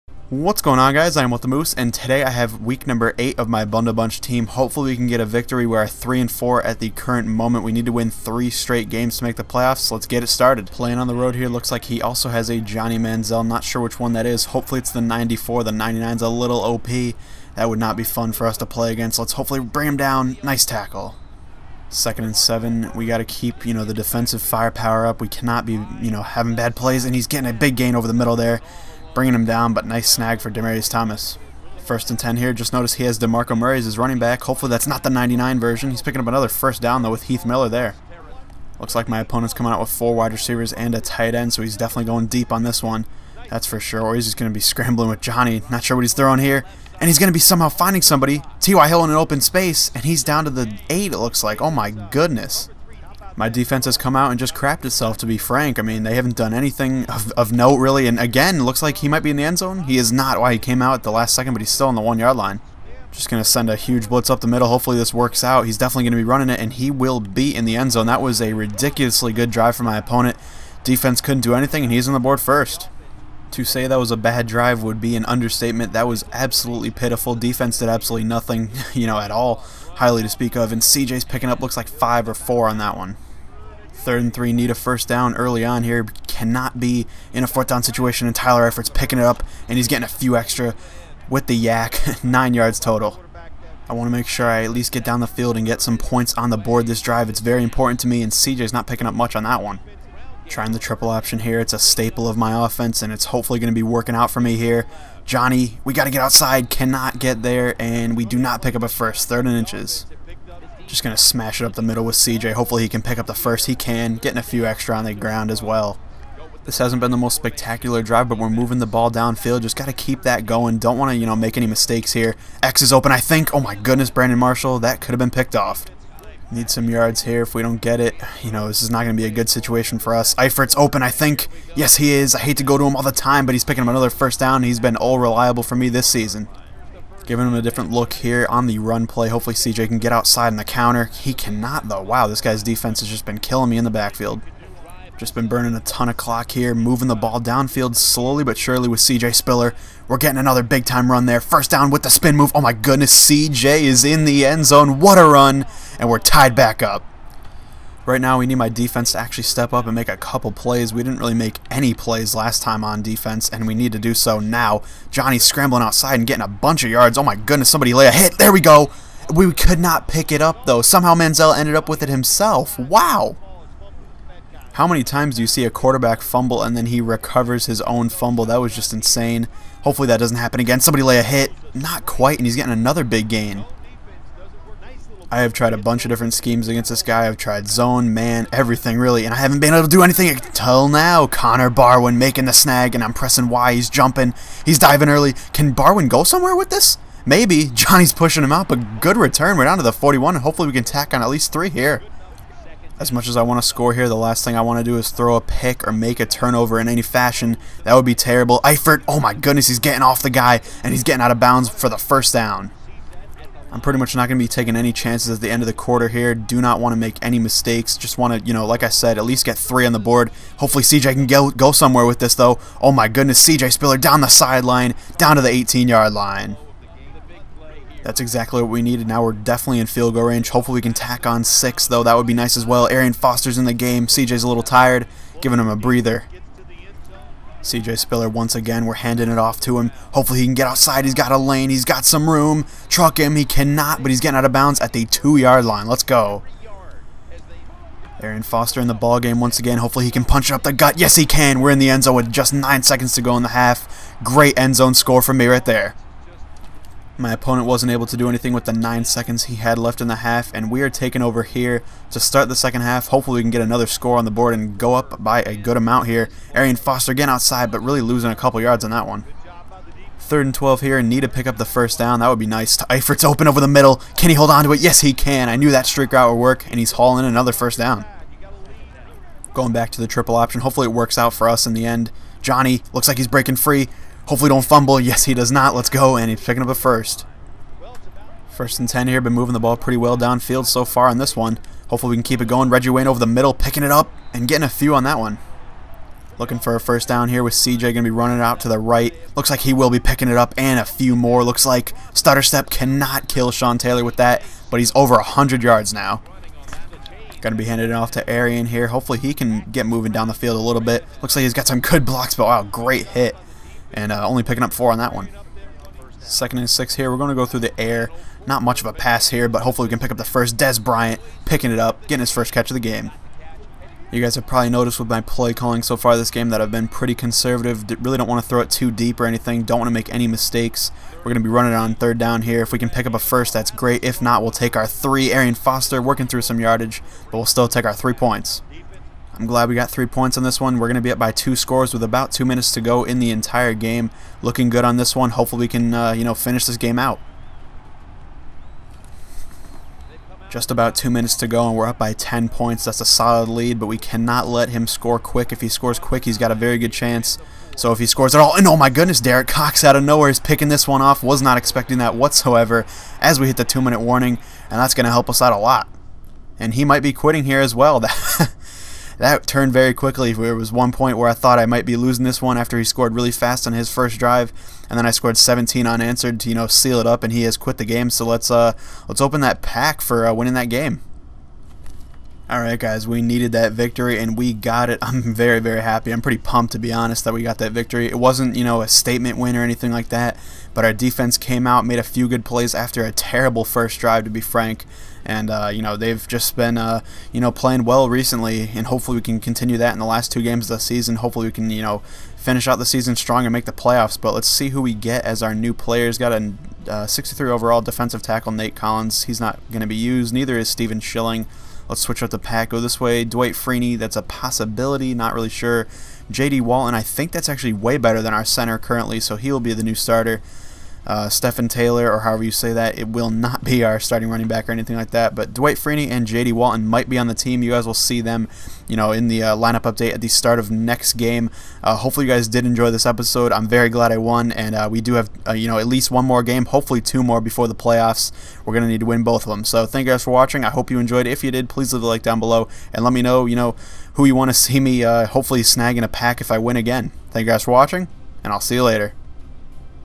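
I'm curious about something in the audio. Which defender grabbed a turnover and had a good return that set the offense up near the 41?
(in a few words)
Connor Barwin.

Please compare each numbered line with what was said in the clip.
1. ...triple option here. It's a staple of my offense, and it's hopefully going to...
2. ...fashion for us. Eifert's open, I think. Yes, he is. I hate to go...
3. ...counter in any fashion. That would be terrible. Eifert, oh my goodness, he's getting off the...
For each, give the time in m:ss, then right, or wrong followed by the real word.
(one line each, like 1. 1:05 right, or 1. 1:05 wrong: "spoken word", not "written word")
1. 1:40 right
2. 2:09 wrong: "situation", not "fashion"
3. 3:26 wrong: "turnover", not "counter".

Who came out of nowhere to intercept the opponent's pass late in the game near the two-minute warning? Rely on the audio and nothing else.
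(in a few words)
Derek Cox.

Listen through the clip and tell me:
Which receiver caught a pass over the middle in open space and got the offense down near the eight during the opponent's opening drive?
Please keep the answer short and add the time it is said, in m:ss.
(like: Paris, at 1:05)
T.Y. Hilton, at 0:48.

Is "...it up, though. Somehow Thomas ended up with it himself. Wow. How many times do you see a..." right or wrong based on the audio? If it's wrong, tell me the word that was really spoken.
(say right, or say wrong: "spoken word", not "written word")
wrong: "Manziel", not "Thomas".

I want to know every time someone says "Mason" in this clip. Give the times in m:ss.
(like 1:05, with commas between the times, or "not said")
not said.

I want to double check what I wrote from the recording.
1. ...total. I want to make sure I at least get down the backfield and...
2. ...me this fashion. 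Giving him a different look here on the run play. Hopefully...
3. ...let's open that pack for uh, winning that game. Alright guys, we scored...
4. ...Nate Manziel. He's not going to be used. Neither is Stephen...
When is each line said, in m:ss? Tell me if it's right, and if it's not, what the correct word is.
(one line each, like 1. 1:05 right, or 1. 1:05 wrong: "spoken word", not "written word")
1. 1:32 wrong: "field", not "backfield"
2. 2:15 wrong: "season", not "fashion"
3. 6:19 wrong: "needed", not "scored"
4. 6:48 wrong: "Collins", not "Manziel".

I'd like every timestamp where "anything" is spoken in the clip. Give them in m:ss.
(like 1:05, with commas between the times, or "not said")
0:56, 1:11, 3:10, 4:18, 5:29, 6:29, 7:04.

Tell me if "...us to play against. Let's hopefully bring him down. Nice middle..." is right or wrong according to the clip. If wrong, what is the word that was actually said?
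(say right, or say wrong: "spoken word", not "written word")
wrong: "tackle", not "middle".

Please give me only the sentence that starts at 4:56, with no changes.
Looking for a first down here with CJ going to be running out to the right.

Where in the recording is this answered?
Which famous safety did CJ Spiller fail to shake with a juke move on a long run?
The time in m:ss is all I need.
5:03.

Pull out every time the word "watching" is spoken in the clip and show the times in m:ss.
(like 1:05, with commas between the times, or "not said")
7:20, 7:27.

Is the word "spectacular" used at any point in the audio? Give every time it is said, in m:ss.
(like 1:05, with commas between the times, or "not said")
1:57.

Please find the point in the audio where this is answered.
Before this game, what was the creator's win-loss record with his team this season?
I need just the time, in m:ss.
0:05.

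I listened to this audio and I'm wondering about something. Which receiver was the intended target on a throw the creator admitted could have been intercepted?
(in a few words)
Brandon Marshall.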